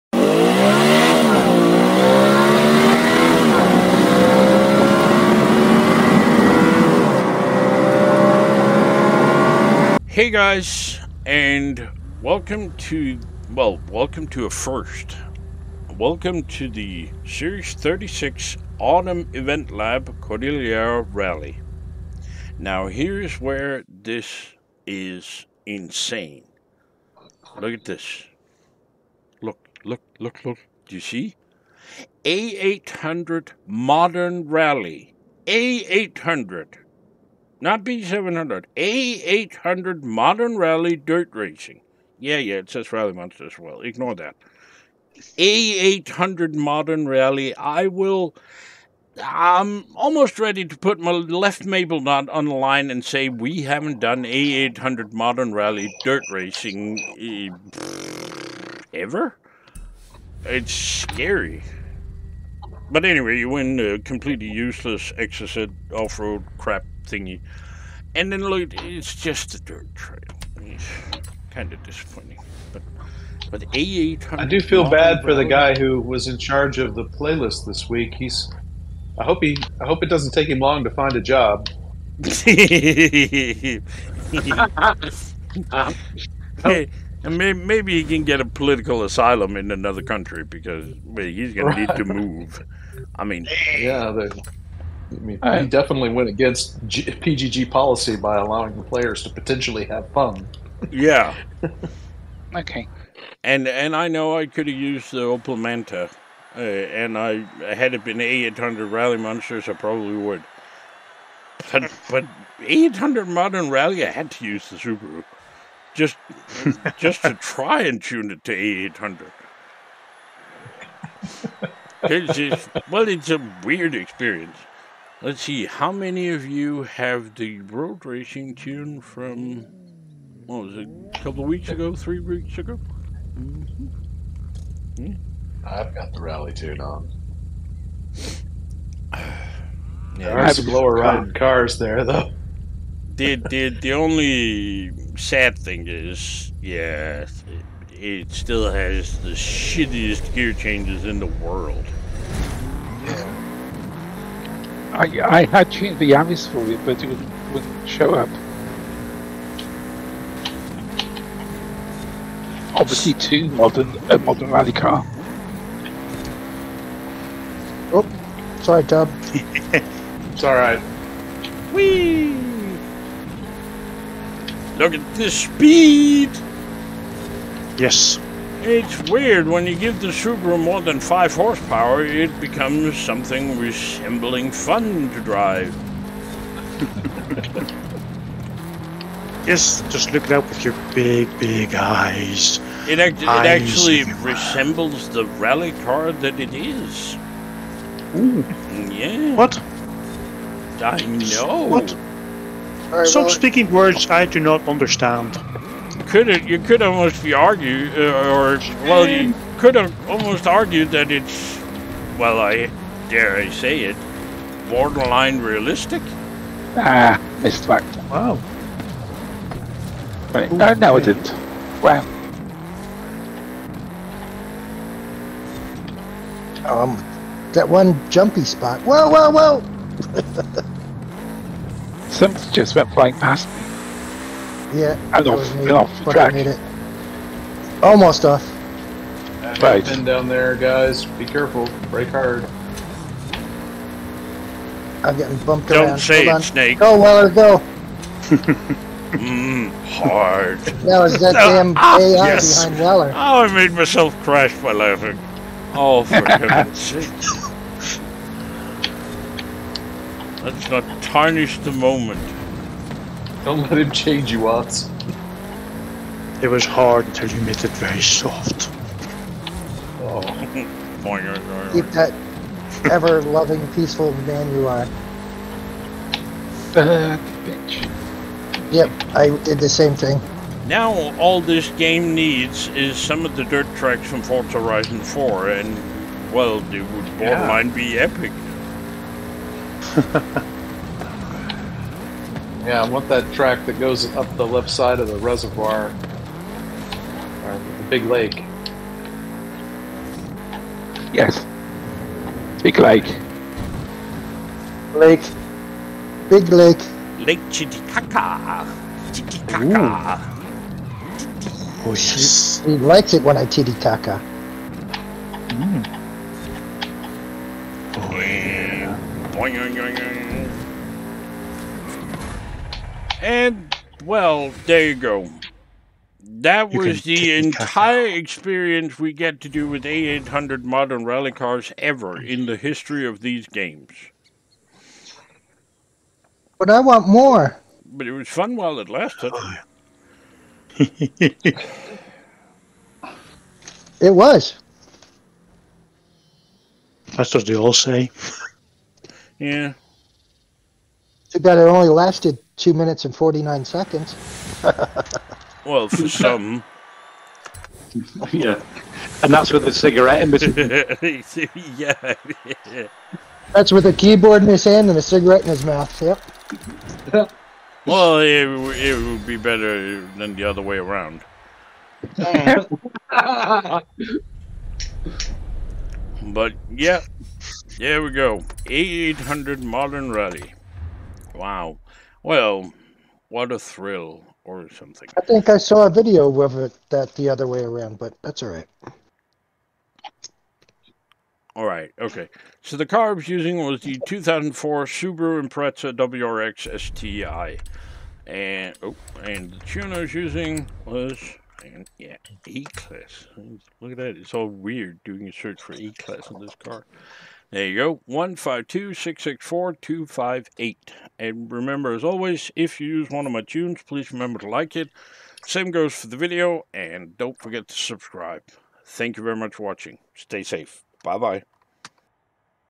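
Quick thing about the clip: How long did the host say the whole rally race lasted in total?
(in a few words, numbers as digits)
2 minutes and 49 seconds.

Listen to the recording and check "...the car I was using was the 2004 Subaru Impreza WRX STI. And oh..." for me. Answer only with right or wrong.
right.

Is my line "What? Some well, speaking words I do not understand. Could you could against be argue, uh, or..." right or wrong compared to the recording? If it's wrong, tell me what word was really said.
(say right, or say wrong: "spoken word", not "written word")
wrong: "almost", not "against".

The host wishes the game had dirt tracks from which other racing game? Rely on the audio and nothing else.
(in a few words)
Forza Horizon 4.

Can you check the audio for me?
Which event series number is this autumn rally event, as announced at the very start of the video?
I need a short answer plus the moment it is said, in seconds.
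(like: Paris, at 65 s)
Series 36, at 17 s.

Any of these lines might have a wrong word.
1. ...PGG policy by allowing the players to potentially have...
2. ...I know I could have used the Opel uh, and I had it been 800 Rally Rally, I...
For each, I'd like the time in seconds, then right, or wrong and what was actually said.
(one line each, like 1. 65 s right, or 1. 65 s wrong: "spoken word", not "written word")
1. 97 s right
2. 103 s wrong: "Monsters", not "Rally".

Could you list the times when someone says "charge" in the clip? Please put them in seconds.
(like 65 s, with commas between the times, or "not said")
76 s.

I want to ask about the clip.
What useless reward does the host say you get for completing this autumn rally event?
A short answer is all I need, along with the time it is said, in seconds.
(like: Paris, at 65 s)
exocet, at 65 s.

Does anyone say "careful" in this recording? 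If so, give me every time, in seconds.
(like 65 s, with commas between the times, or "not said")
241 s.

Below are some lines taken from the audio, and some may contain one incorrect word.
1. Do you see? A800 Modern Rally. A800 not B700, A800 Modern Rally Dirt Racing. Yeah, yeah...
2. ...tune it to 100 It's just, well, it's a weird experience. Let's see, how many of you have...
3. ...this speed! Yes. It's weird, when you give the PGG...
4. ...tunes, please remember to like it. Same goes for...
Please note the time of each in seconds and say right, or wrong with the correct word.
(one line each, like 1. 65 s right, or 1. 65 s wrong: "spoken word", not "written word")
1. 30 s right
2. 118 s wrong: "800", not "100"
3. 175 s wrong: "Subaru", not "PGG"
4. 413 s right.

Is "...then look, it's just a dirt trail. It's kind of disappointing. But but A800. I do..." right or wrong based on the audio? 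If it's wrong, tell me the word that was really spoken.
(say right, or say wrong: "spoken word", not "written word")
right.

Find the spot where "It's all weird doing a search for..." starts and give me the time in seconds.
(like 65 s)
404 s.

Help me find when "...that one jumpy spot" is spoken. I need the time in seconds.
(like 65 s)
227 s.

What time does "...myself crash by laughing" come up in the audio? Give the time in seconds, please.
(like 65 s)
253 s.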